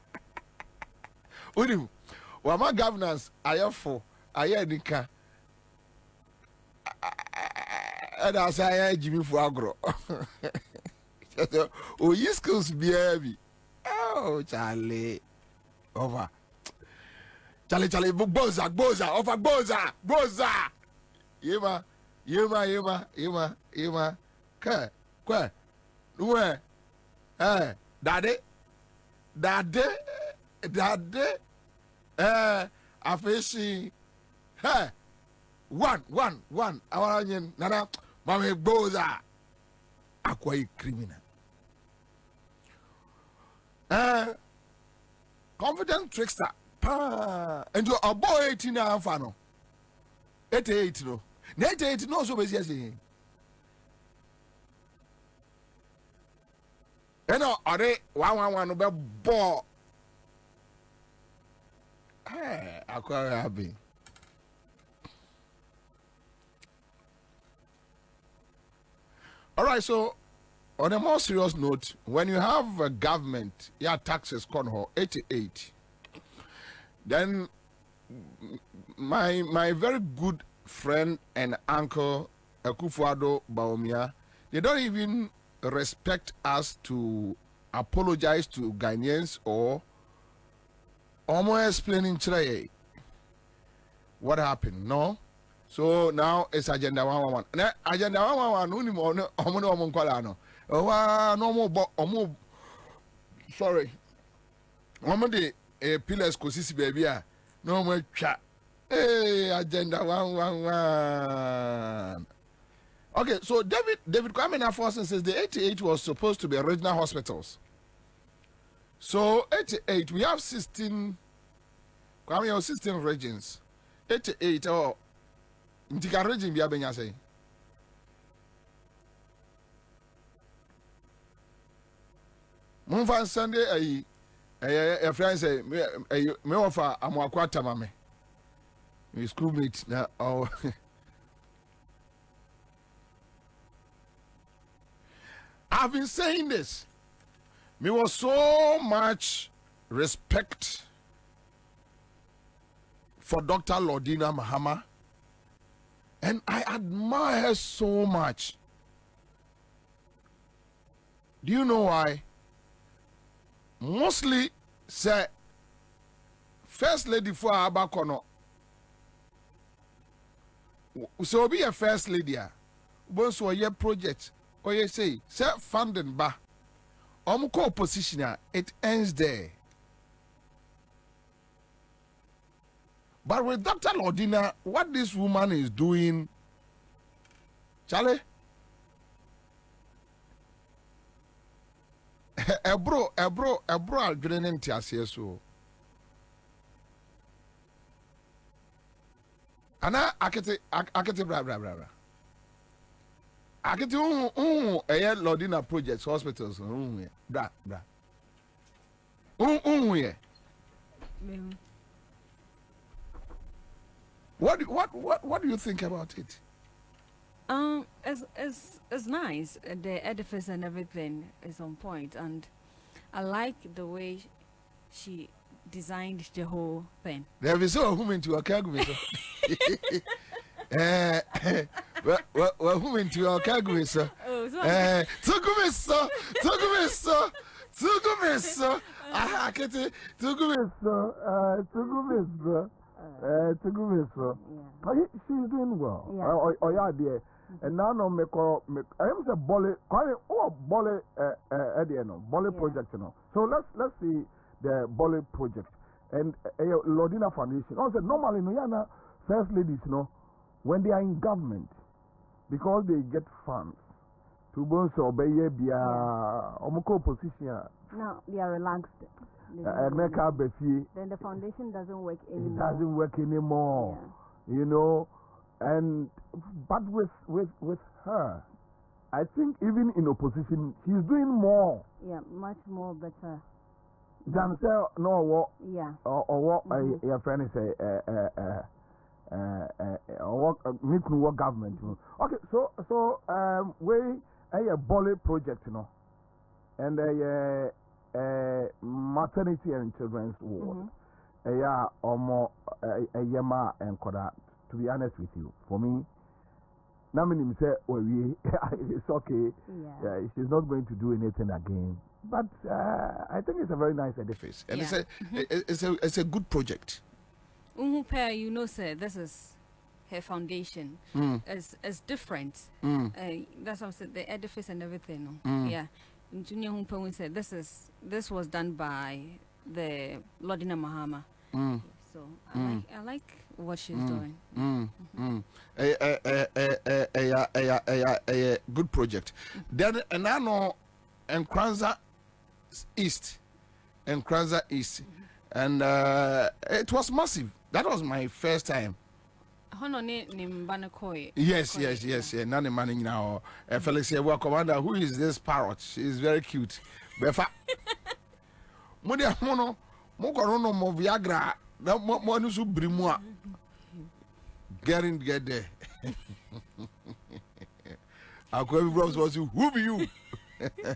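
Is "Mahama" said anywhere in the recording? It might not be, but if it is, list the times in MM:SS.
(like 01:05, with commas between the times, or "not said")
02:34, 05:30.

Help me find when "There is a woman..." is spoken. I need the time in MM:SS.
03:47.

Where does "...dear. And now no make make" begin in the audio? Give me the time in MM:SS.
04:06.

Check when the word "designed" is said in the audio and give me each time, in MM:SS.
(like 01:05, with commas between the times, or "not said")
03:45.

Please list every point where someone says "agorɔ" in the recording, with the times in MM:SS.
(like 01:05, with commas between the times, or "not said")
00:09.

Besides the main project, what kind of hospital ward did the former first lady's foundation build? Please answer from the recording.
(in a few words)
maternity and children's ward.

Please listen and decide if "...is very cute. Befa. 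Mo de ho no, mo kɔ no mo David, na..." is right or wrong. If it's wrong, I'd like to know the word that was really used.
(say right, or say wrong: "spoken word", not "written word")
wrong: "Viagra", not "David".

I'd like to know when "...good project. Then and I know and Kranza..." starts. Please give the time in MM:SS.
05:38.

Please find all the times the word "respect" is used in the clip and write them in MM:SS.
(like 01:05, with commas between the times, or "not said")
01:25, 02:29.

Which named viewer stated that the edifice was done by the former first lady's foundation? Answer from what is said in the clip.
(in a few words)
Junior Humpong.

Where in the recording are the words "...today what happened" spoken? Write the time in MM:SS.
01:32.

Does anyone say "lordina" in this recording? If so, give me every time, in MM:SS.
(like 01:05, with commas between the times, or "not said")
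02:33, 03:03, 04:16, 05:30.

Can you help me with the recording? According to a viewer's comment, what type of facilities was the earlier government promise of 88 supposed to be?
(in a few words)
regional hospitals.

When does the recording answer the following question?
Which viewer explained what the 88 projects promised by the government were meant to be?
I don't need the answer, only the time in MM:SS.
01:54.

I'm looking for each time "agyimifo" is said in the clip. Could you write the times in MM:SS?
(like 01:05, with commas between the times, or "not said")
00:08.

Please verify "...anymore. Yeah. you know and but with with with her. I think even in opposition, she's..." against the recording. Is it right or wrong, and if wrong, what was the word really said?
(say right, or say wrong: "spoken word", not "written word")
right.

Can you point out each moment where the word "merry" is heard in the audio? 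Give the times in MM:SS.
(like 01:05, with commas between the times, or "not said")
not said.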